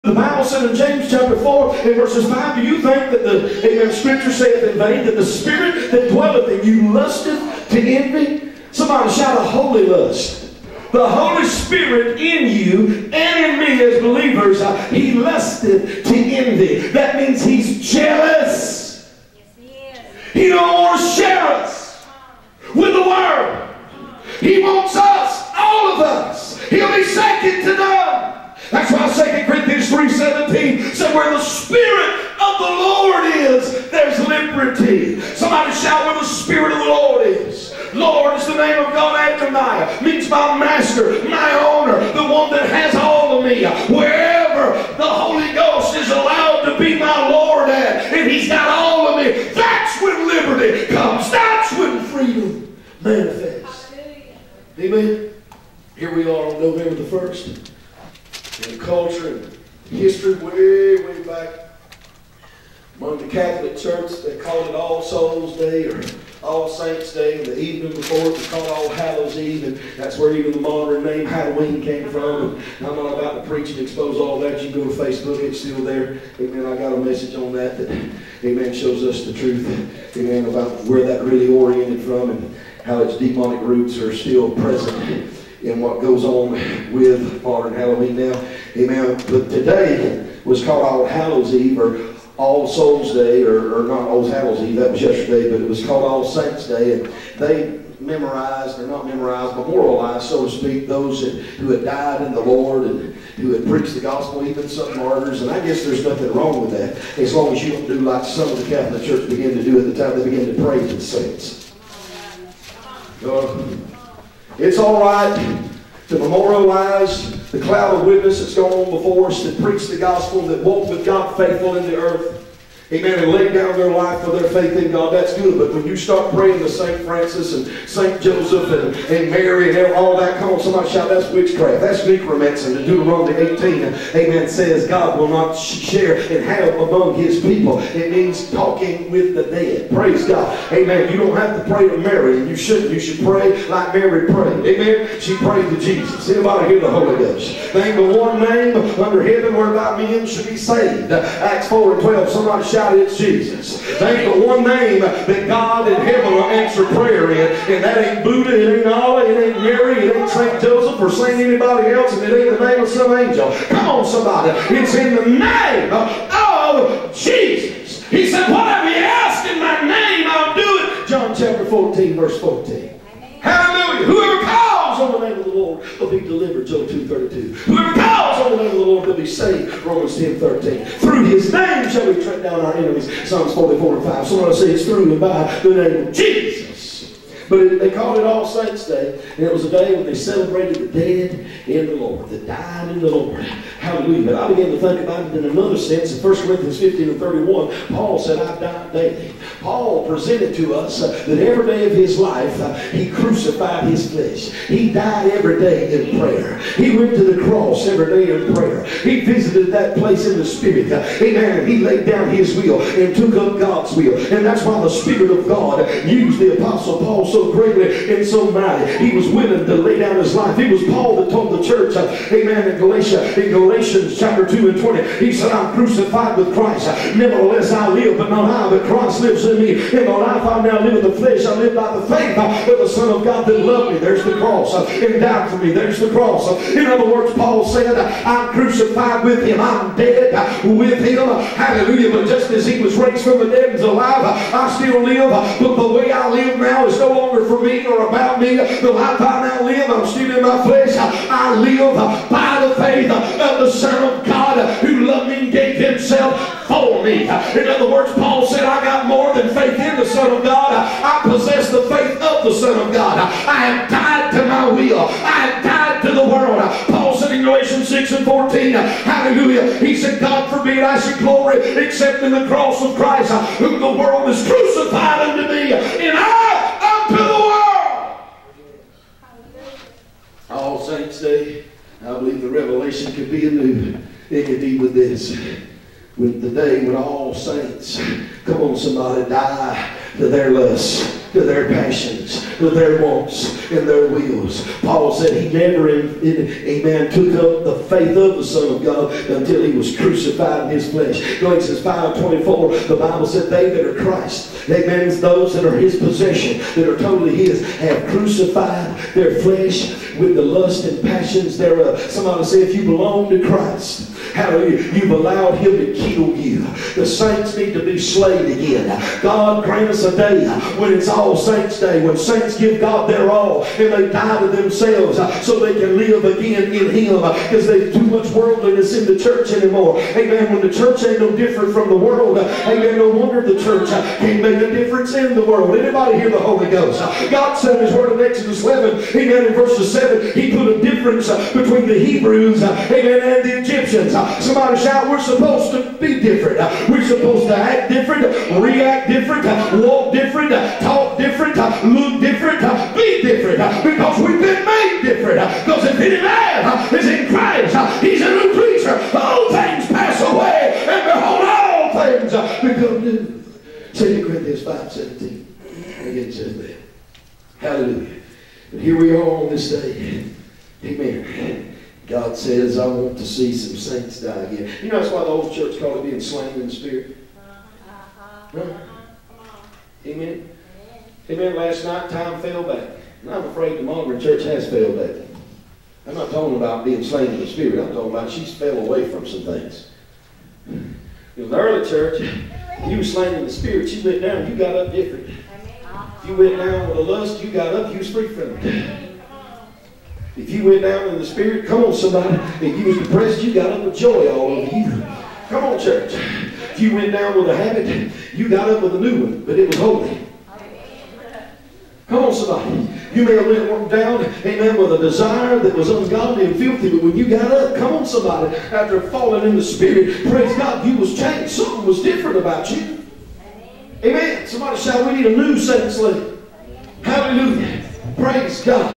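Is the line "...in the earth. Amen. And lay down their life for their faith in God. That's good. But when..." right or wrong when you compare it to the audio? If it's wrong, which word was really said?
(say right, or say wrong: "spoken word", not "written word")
right.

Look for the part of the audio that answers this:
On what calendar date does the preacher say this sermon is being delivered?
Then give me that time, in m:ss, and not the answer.
0:56.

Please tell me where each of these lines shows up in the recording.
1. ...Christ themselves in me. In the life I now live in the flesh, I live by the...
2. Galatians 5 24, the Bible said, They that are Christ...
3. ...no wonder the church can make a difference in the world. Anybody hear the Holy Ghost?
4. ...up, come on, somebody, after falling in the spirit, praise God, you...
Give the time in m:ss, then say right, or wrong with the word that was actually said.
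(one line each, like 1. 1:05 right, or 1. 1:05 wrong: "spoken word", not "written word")
1. 3:48 wrong: "lives", not "themselves"
2. 5:01 right
3. 5:32 right
4. 6:57 right.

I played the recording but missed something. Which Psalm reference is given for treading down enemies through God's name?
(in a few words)
Psalms 44:5.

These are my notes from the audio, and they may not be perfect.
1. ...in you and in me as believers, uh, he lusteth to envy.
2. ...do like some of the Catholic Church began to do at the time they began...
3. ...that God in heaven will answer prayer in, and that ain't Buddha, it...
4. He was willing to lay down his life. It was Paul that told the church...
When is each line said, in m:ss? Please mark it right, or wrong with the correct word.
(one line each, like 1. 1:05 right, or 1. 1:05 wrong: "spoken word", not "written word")
1. 0:12 right
2. 1:47 right
3. 2:35 right
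4. 3:39 right.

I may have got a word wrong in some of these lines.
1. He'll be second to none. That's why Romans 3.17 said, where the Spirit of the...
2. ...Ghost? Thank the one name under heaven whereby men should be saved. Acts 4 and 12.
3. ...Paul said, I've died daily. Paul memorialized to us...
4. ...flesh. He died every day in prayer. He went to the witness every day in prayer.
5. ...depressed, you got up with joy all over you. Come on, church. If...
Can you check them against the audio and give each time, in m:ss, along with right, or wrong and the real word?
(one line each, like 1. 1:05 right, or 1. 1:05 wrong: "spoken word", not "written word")
1. 0:26 wrong: "Second", not "Romans"
2. 2:27 right
3. 3:17 wrong: "presented", not "memorialized"
4. 3:24 wrong: "cross", not "witness"
5. 6:42 right.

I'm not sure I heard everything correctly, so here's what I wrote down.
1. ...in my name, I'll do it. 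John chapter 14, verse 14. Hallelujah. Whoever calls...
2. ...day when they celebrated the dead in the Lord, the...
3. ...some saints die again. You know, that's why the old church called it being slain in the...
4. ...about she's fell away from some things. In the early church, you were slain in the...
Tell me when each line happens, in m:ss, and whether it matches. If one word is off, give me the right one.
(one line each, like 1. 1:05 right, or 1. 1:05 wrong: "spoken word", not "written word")
1. 2:49 right
2. 3:09 right
3. 6:13 right
4. 6:28 right.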